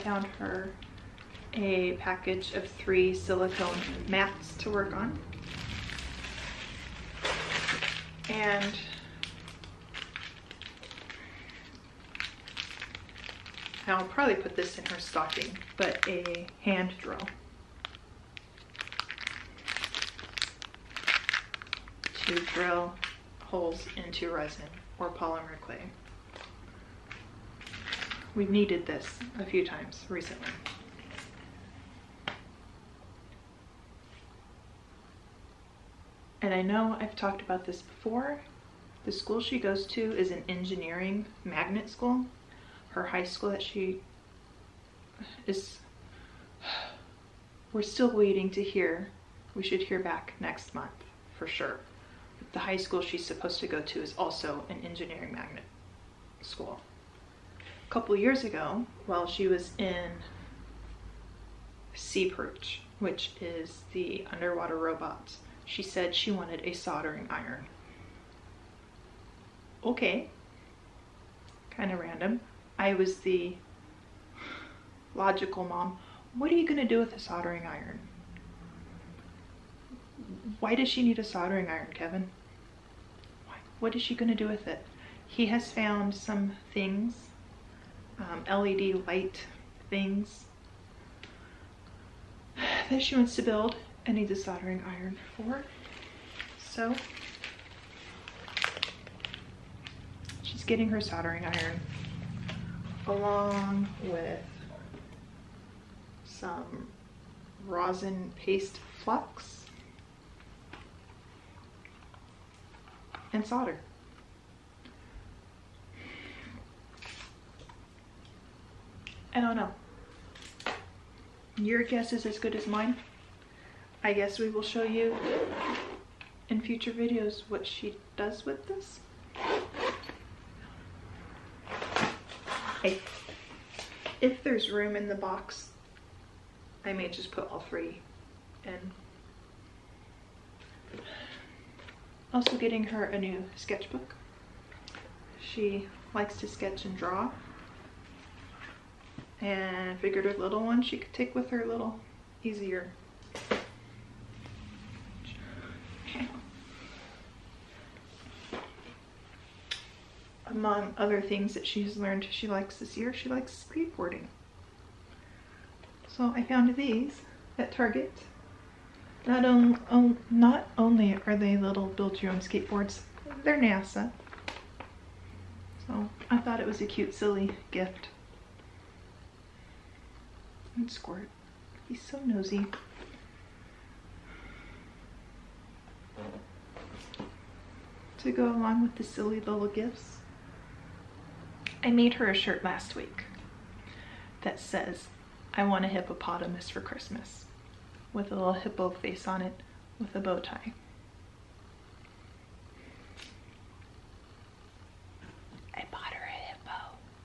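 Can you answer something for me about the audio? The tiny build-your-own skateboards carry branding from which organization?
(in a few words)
NASA.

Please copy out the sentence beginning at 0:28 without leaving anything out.
We've needed this a few times recently.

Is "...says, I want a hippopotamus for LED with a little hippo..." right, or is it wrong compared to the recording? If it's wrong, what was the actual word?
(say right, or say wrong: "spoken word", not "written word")
wrong: "Christmas", not "LED".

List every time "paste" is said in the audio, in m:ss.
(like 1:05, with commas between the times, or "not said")
1:48.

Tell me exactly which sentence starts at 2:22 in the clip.
Also getting her a new sketchbook.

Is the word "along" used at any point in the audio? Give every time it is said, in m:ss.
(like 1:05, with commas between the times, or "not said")
1:43, 3:08.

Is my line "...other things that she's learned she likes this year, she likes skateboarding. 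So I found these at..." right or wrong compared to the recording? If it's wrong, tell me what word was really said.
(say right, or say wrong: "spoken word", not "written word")
right.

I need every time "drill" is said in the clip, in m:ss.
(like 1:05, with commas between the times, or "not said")
0:17, 0:22.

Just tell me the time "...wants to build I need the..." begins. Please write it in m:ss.
1:33.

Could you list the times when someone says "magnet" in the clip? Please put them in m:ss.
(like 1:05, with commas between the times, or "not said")
0:41, 0:55.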